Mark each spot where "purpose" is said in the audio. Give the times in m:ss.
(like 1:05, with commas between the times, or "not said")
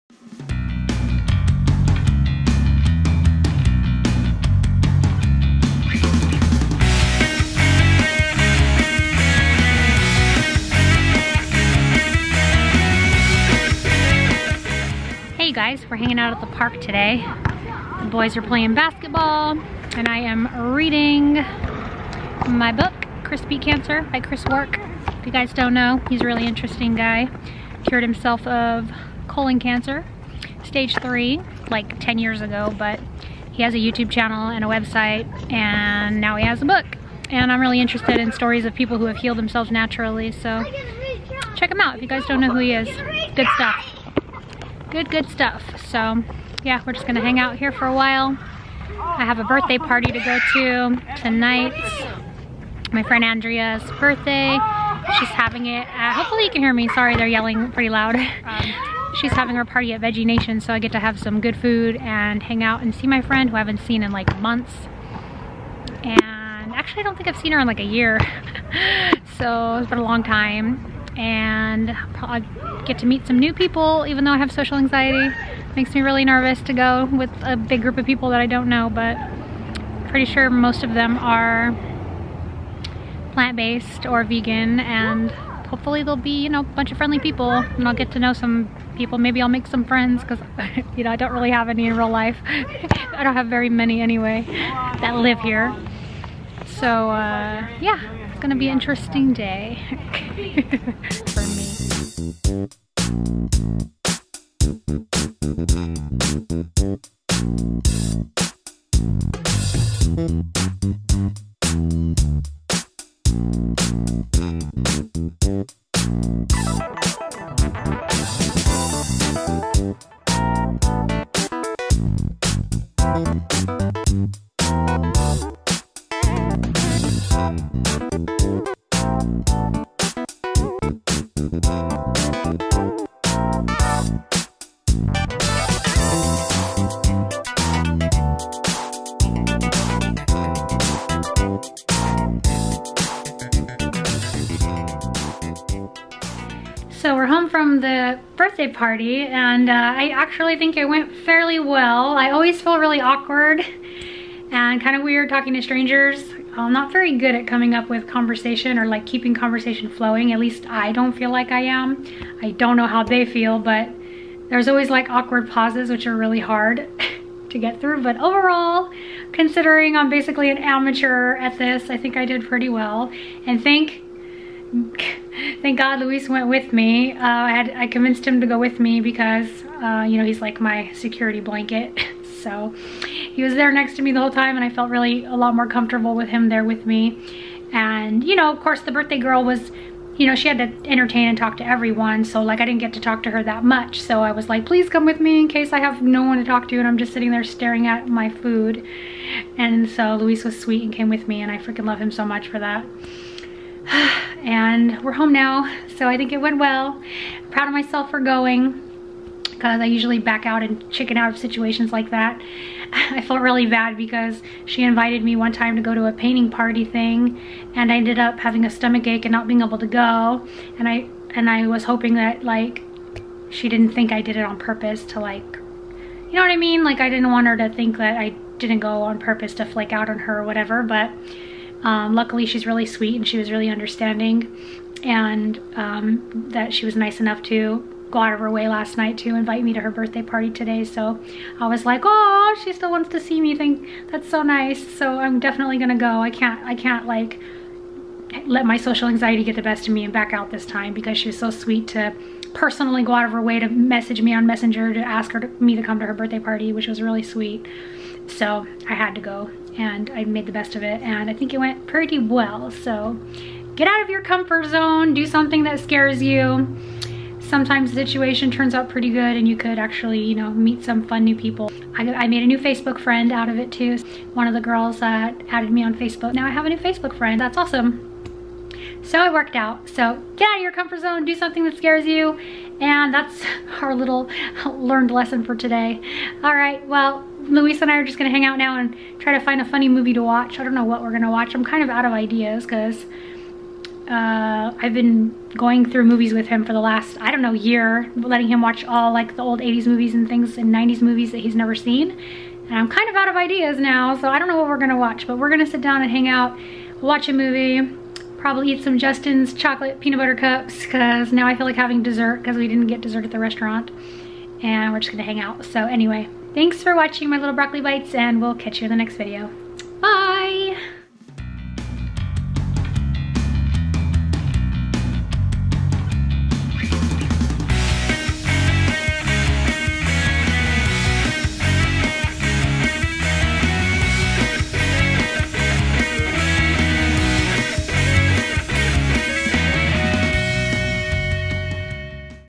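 3:44, 3:49.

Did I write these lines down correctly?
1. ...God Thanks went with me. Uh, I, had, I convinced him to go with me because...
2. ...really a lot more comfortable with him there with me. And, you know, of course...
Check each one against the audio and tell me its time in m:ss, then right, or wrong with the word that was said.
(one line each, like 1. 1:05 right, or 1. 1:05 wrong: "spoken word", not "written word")
1. 2:55 wrong: "Luis", not "Thanks"
2. 3:04 right.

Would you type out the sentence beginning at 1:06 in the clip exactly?
And actually, I don't think I've seen her in like a year.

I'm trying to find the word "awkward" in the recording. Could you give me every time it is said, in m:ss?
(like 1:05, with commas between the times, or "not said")
2:33, 2:45.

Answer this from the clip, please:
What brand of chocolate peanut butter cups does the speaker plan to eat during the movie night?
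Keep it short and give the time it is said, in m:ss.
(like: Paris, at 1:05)
Justin's, at 5:08.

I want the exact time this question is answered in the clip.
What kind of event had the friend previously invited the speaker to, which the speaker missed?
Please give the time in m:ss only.
3:36.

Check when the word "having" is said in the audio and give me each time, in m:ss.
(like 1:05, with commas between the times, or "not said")
0:55, 0:59, 3:38, 5:11.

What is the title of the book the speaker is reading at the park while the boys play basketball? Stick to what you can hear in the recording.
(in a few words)
Chris Beat Cancer.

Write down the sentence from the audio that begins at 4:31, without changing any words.
I, I made a new Facebook friend out of it too.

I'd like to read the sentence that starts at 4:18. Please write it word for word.
So I had to go and I made the best of it and I think it went pretty well.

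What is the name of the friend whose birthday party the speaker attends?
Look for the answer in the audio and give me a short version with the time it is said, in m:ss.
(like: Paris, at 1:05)
Andrea, at 0:53.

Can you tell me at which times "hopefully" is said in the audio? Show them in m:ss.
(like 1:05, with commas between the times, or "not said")
0:56, 1:25.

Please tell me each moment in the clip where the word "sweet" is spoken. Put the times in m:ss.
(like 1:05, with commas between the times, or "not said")
3:20, 3:52, 4:11, 4:17.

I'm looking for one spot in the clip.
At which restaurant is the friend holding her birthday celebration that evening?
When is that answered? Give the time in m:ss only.
1:00.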